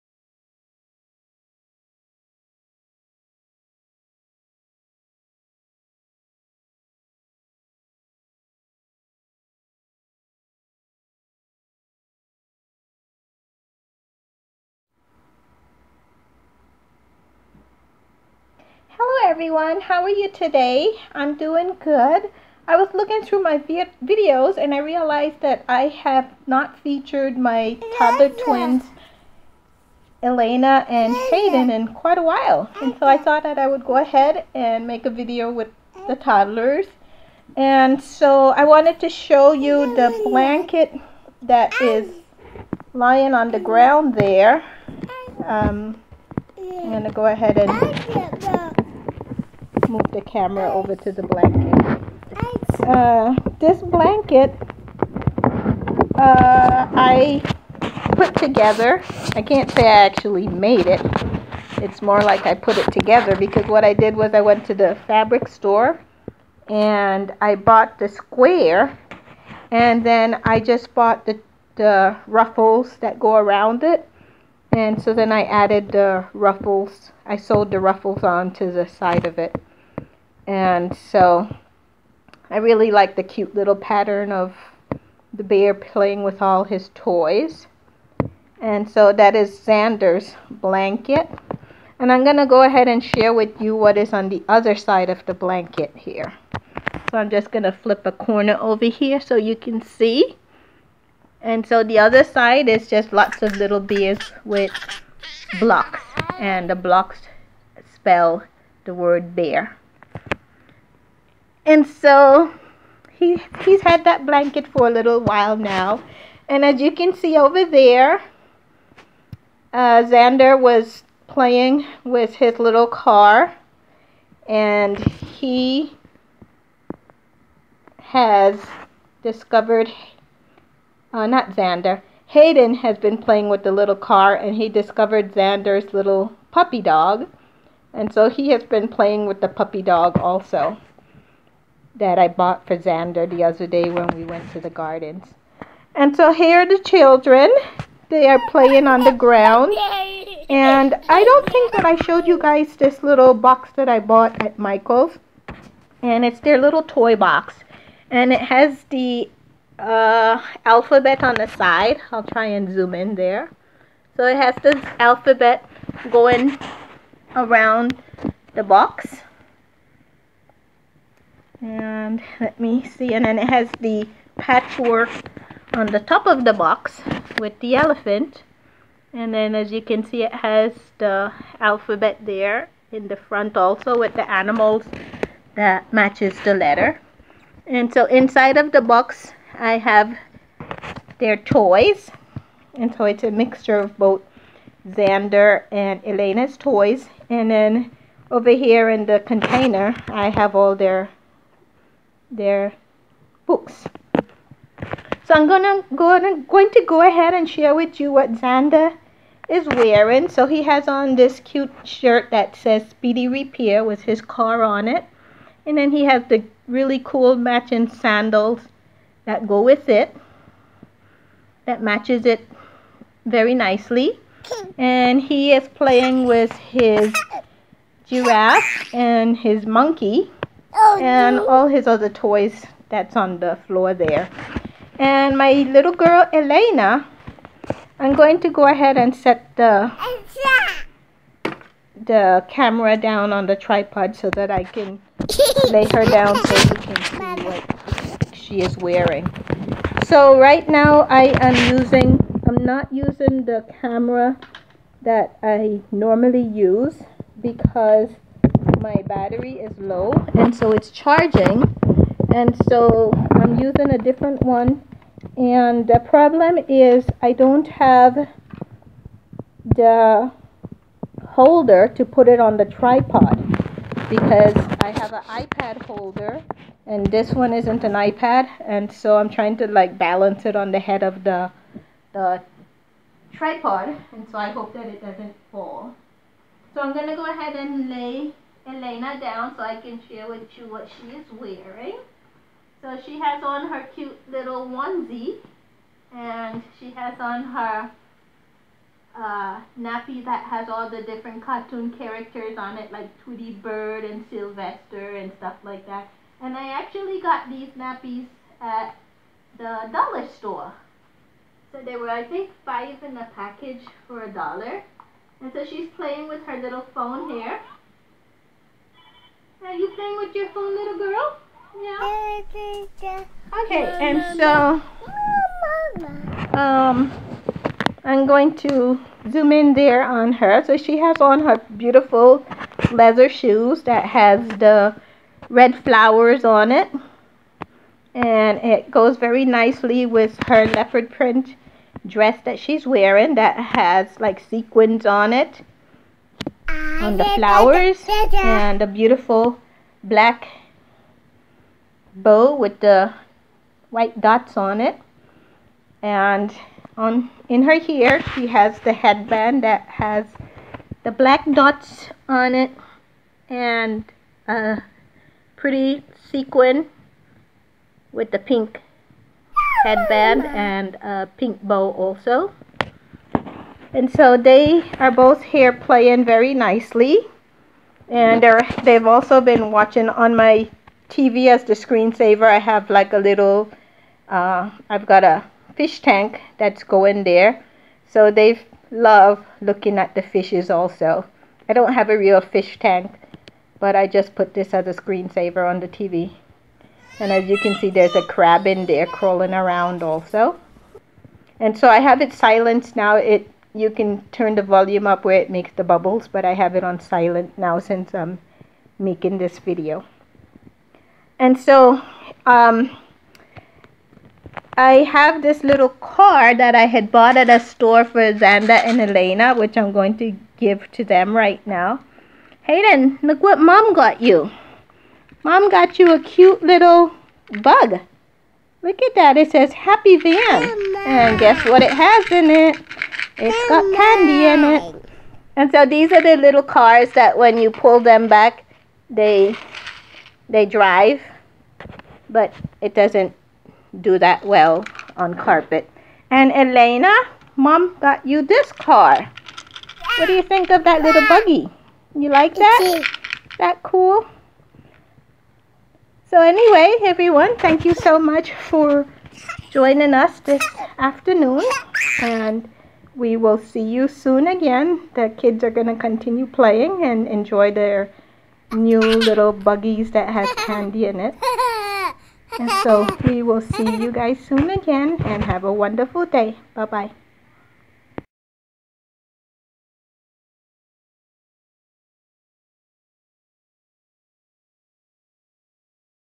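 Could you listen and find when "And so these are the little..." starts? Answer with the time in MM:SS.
07:15.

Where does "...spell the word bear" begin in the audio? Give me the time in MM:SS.
01:47.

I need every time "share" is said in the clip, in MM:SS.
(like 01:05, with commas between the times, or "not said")
01:33, 03:27, 04:50.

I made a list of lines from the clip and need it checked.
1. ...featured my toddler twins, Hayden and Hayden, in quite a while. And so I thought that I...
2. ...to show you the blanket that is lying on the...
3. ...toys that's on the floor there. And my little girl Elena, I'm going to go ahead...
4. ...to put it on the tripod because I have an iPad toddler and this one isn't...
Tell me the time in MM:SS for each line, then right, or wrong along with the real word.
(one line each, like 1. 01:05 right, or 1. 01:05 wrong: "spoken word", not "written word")
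1. 00:26 wrong: "Elena", not "Hayden"
2. 00:38 right
3. 03:52 right
4. 04:31 wrong: "holder", not "toddler".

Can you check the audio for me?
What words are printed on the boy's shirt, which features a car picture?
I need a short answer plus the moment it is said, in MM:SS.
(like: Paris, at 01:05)
Speedy Repair, at 03:32.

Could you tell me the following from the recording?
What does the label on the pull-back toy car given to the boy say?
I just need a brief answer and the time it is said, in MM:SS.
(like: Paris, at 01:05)
happy van, at 07:09.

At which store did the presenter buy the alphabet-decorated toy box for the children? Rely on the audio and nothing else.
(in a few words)
Michael's.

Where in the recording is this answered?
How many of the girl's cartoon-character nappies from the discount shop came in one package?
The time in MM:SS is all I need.
05:12.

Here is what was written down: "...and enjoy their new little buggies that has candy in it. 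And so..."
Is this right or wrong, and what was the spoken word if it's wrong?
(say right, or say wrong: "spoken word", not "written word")
right.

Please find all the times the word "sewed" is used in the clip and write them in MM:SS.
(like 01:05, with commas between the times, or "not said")
01:17.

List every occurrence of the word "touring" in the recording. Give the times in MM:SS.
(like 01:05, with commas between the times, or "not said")
not said.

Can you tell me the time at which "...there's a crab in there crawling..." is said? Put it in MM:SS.
06:37.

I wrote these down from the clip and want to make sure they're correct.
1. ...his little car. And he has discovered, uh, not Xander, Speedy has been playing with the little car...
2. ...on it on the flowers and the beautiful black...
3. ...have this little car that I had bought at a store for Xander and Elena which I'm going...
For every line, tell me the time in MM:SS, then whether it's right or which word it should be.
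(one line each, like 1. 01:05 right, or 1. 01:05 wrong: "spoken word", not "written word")
1. 02:02 wrong: "Hayden", not "Speedy"
2. 05:45 right
3. 06:55 right.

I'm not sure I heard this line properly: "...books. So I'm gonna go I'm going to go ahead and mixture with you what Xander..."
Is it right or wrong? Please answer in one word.
wrong.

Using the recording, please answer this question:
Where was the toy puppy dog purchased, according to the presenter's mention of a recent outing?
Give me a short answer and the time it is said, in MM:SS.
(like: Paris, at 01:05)
the gardens, at 02:24.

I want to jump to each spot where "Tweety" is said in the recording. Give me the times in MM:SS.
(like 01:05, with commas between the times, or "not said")
05:03.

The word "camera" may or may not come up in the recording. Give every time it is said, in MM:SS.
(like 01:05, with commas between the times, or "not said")
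00:50, 04:02, 04:13.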